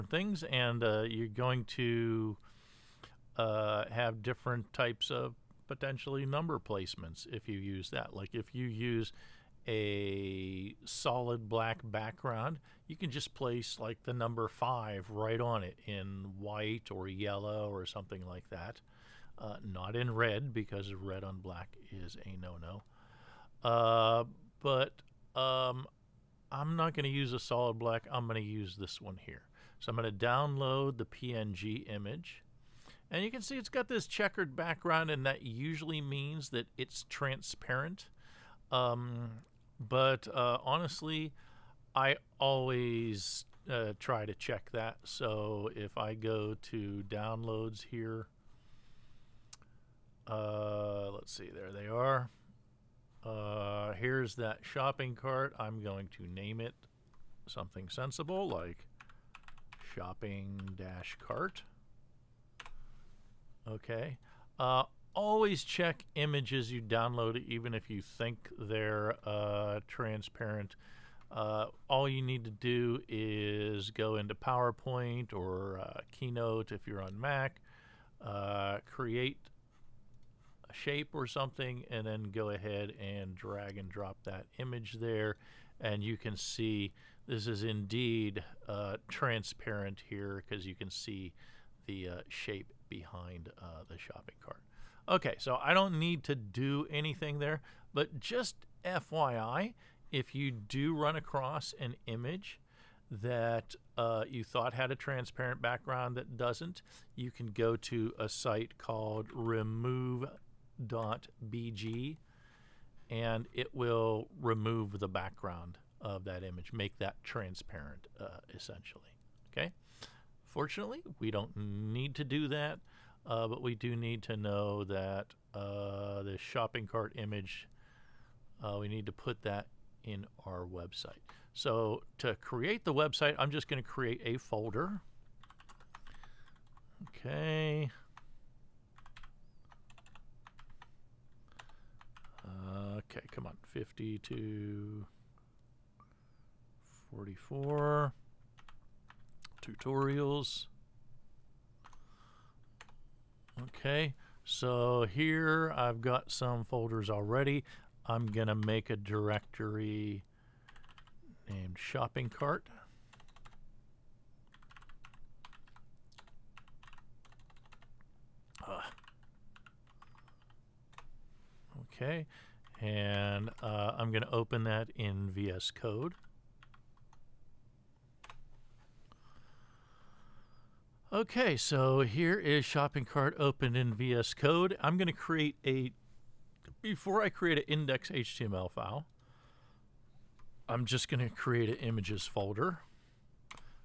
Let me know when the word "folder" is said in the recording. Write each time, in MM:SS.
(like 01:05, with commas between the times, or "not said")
02:14, 02:36, 03:12.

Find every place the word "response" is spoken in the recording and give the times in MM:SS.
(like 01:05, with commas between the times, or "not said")
not said.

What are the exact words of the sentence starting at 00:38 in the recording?
Um, but uh, honestly, I always uh, try to check that.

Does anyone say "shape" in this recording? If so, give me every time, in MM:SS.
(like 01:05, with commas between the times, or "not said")
01:20, 01:32.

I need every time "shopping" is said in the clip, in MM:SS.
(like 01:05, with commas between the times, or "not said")
00:54, 00:59, 01:33, 02:06, 02:41, 03:02.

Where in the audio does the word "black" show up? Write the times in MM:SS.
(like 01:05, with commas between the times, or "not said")
00:11, 00:21, 00:27.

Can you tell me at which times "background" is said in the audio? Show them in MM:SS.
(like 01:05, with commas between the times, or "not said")
00:11, 00:34, 01:45, 01:55.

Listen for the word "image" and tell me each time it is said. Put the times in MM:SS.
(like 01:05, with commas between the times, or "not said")
00:31, 01:06, 01:24, 01:42, 01:56, 02:07, 03:11.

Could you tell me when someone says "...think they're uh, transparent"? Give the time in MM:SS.
01:08.